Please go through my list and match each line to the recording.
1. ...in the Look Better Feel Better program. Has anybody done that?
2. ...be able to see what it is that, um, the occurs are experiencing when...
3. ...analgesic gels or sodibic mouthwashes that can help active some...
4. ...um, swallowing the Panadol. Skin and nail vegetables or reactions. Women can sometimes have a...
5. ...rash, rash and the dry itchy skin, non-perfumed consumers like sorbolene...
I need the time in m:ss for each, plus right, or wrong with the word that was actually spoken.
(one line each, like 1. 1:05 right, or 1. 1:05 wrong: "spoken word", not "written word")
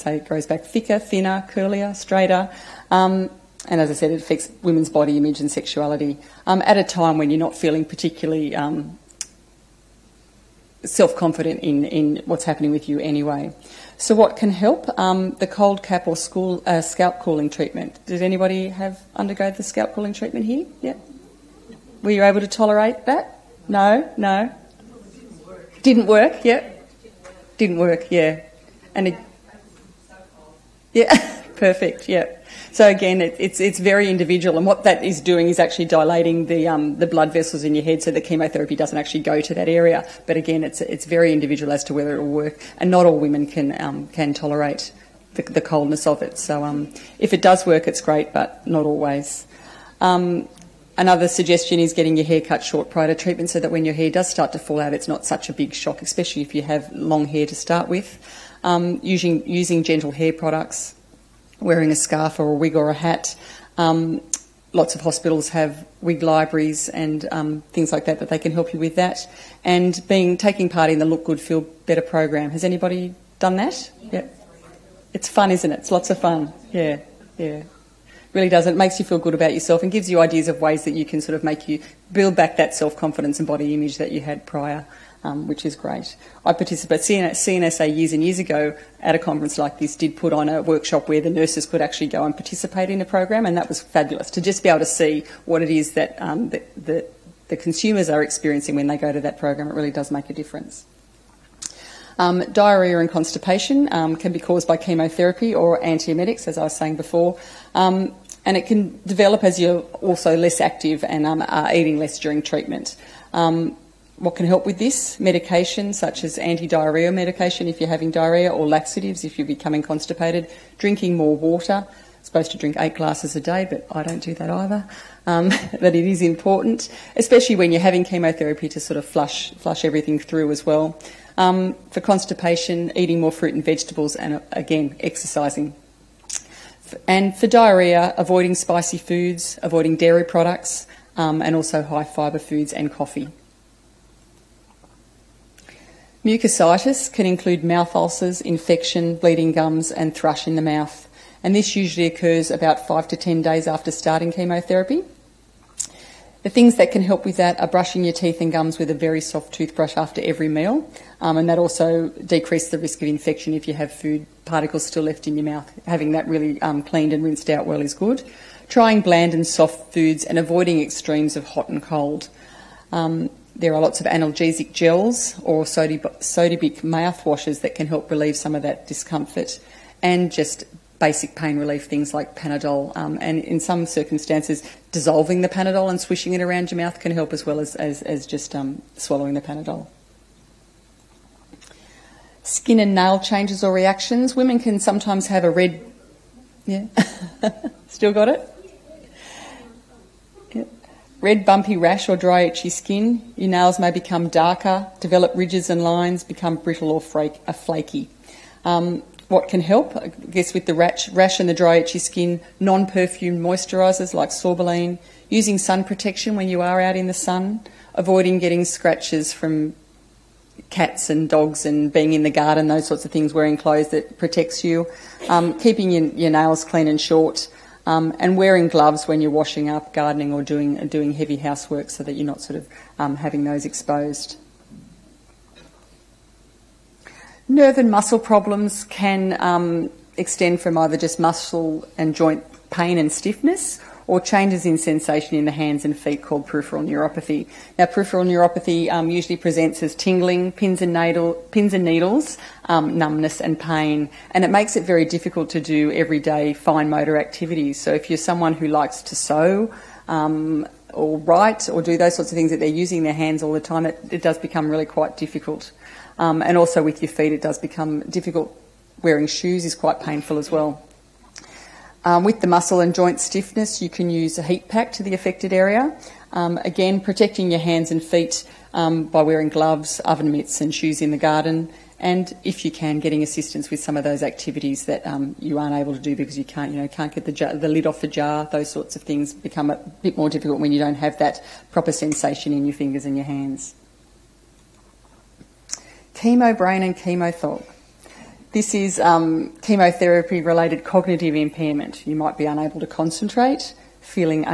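1. 1:10 wrong: "Good", not "Better"
2. 1:34 wrong: "consumers", not "occurs"
3. 2:54 wrong: "relieve", not "active"
4. 3:08 wrong: "changes", not "vegetables"
5. 3:30 wrong: "moisturisers", not "consumers".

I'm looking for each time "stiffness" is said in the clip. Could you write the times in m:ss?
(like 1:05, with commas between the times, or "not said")
4:03, 4:33.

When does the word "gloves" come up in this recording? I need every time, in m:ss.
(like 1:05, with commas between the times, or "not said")
3:48, 4:39.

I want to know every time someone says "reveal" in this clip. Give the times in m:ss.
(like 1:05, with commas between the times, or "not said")
not said.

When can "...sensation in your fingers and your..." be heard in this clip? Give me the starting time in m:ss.
4:51.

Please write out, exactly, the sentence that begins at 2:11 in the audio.
Um, for constipation, eating more fruit and vegetables, and again, exercising.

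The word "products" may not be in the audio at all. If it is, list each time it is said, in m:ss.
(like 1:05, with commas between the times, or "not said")
1:00, 2:20.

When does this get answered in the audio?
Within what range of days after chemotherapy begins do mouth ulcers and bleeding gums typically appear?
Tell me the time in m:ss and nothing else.
2:32.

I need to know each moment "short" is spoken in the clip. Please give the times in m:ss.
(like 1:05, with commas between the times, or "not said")
0:52, 3:47.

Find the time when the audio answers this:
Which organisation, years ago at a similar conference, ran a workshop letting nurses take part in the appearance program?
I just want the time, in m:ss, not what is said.
1:27.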